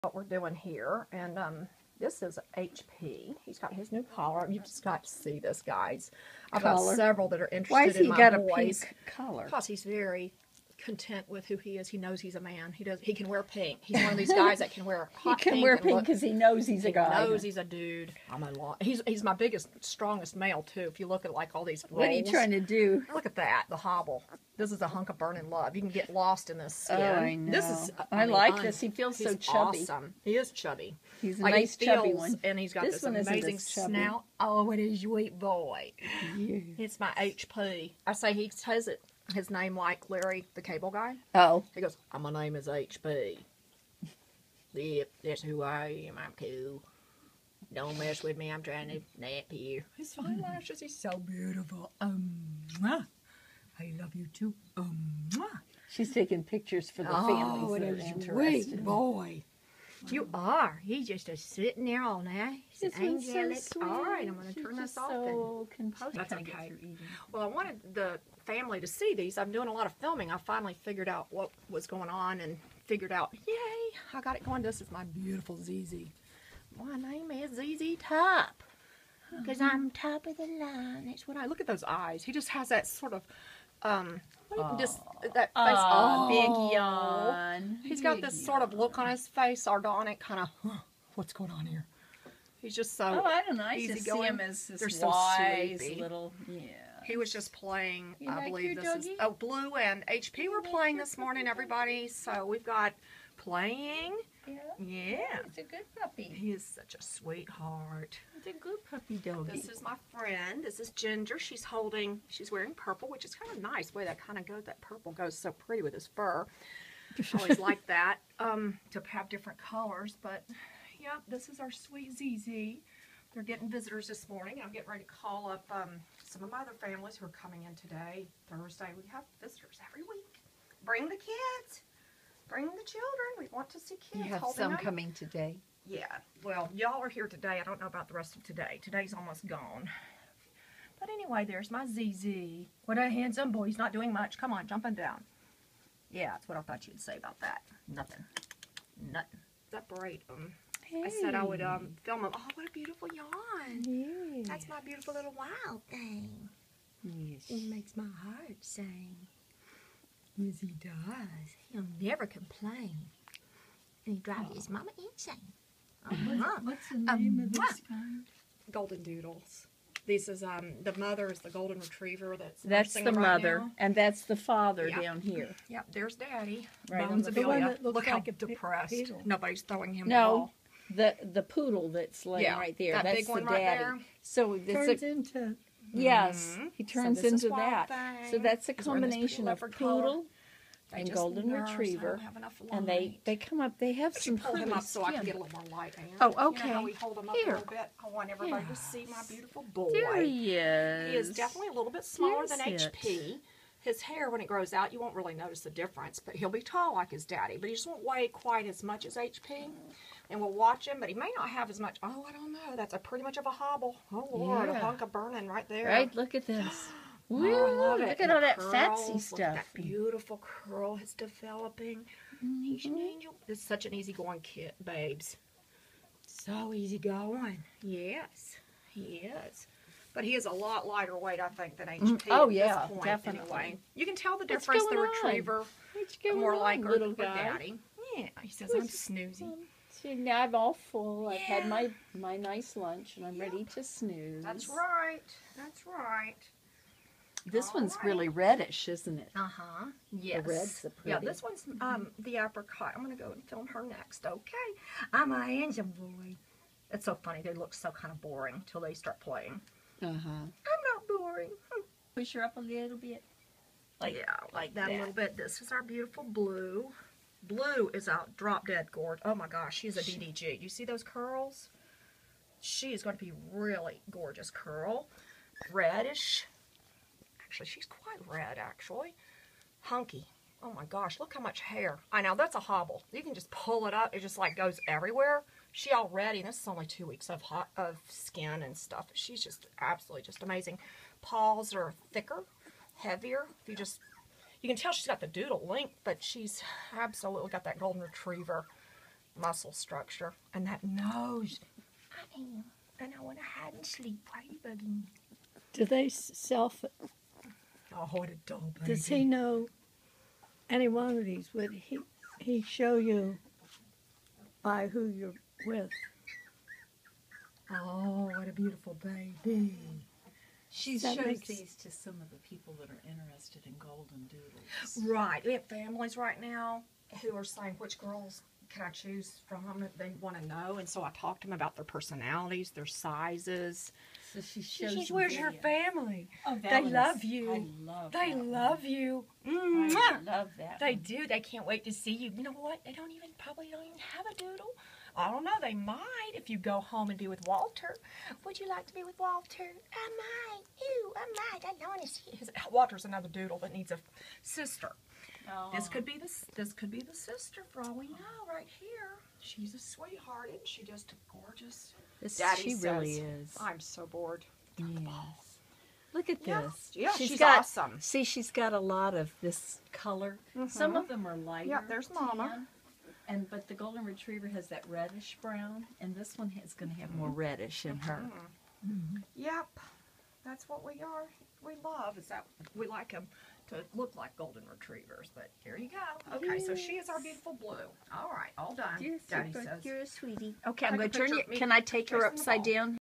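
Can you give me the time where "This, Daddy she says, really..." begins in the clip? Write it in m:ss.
6:02.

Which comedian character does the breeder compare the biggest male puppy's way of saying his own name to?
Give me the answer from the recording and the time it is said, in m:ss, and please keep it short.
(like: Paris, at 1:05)
Larry the Cable Guy, at 0:40.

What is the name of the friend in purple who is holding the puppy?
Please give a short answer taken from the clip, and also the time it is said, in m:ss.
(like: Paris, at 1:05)
Ginger, at 1:50.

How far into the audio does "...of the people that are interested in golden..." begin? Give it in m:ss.
5:22.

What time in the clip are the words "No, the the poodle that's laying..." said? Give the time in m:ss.
3:00.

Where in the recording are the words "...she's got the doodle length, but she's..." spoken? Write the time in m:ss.
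4:54.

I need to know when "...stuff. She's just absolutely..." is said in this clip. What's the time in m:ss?
4:48.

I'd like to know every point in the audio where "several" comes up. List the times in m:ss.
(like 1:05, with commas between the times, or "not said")
0:06.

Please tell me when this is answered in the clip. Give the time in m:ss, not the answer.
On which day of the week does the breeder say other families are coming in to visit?
2:08.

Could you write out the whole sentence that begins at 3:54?
The retriever, more on, like little guy.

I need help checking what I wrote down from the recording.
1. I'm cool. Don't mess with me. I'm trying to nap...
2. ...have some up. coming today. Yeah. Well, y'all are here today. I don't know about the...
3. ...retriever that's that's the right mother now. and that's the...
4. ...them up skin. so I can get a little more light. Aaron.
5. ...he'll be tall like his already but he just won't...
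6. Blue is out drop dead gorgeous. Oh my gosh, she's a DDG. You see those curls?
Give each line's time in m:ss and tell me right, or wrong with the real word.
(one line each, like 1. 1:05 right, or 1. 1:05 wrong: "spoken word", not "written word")
1. 0:46 right
2. 2:14 right
3. 2:51 right
4. 3:14 right
5. 3:26 wrong: "daddy", not "already"
6. 4:27 right.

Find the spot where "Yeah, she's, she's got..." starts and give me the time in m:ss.
6:06.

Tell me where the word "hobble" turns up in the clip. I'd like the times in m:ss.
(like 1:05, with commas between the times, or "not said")
0:23, 3:33, 4:42.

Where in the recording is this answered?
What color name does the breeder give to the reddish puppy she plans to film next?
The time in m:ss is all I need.
4:12.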